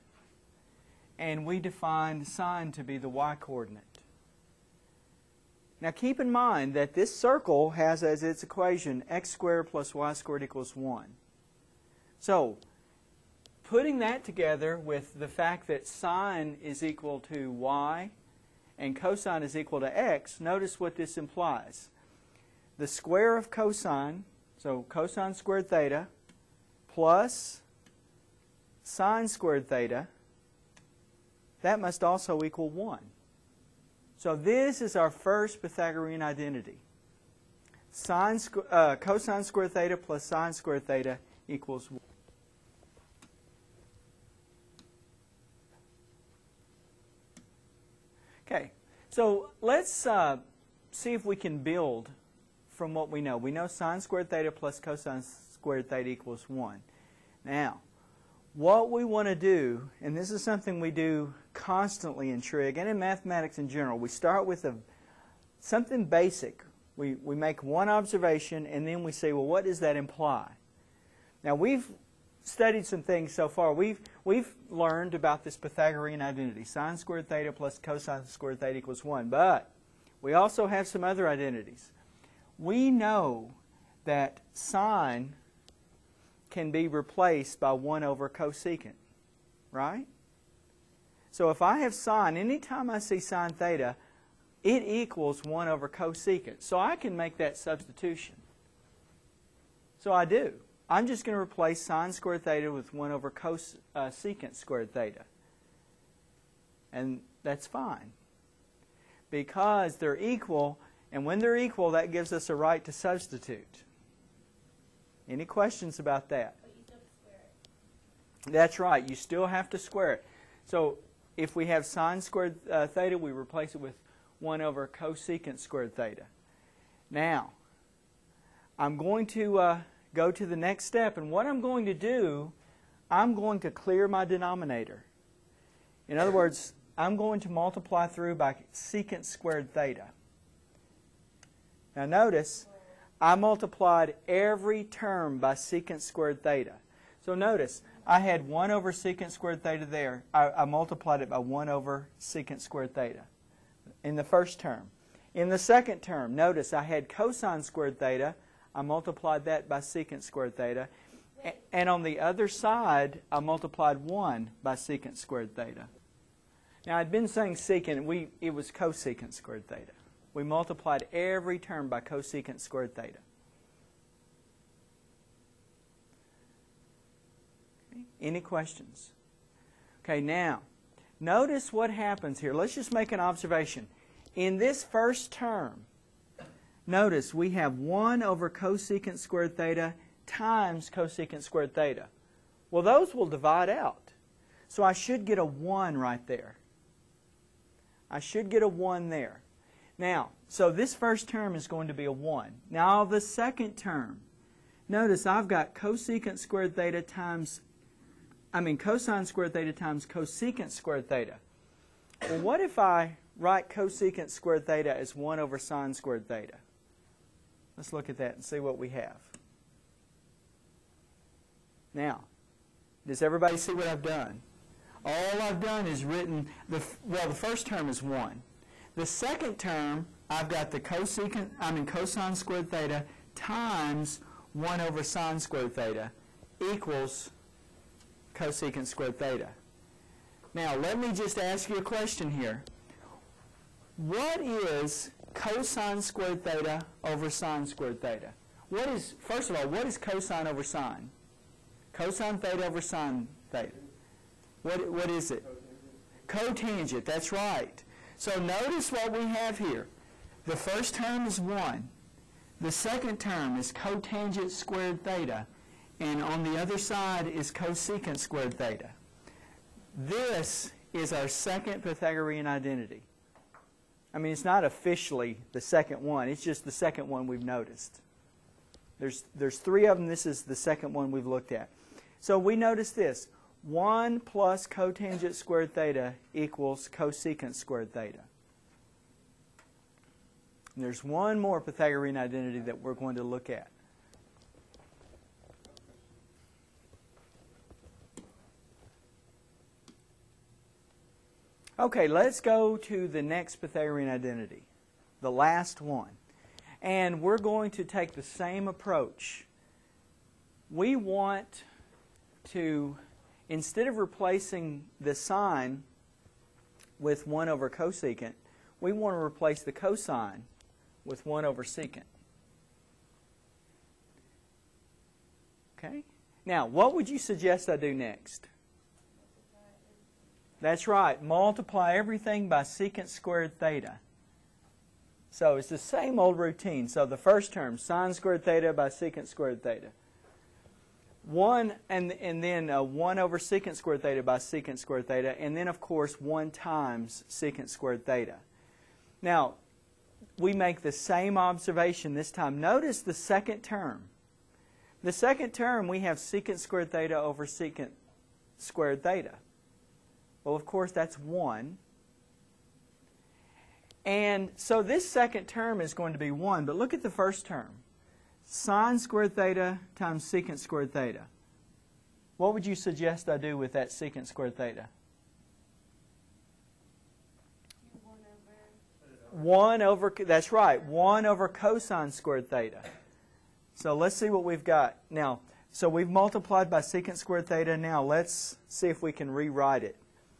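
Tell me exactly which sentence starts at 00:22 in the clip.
The square of cosine, so cosine squared theta, plus sine squared theta, that must also equal 1.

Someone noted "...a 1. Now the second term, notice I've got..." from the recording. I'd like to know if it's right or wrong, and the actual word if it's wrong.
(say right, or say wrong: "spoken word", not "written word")
right.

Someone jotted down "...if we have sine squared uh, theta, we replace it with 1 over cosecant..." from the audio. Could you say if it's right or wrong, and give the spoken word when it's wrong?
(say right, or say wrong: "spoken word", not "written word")
right.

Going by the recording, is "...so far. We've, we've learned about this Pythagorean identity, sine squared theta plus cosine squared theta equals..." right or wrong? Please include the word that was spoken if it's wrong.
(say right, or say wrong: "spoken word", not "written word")
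right.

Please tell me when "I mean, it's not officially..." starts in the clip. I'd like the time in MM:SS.
04:34.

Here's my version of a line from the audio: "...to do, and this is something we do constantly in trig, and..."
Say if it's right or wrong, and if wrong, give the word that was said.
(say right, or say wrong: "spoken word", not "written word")
right.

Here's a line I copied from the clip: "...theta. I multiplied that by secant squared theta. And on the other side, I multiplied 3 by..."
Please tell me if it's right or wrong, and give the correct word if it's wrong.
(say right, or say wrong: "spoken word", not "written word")
wrong: "1", not "3".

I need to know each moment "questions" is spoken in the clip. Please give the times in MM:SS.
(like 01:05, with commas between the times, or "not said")
01:55, 02:58, 04:01.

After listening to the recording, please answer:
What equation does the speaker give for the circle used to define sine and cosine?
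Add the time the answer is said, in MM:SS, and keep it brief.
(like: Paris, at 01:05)
x squared plus y squared equals 1, at 00:09.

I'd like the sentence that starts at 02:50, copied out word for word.
We multiplied every term by cosecant squared theta.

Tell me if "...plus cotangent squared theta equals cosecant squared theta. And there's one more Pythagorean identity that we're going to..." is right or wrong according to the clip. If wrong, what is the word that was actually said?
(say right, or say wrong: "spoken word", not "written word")
right.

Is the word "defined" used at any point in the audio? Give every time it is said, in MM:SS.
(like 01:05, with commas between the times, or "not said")
00:01.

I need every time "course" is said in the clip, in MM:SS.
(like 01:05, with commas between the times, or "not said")
05:45, 06:00.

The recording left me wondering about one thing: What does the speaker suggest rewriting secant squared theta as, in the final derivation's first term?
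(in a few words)
1 over cosine squared theta.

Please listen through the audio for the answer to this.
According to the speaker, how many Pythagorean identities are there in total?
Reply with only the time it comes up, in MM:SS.
04:39.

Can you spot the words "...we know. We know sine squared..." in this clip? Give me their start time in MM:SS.
00:53.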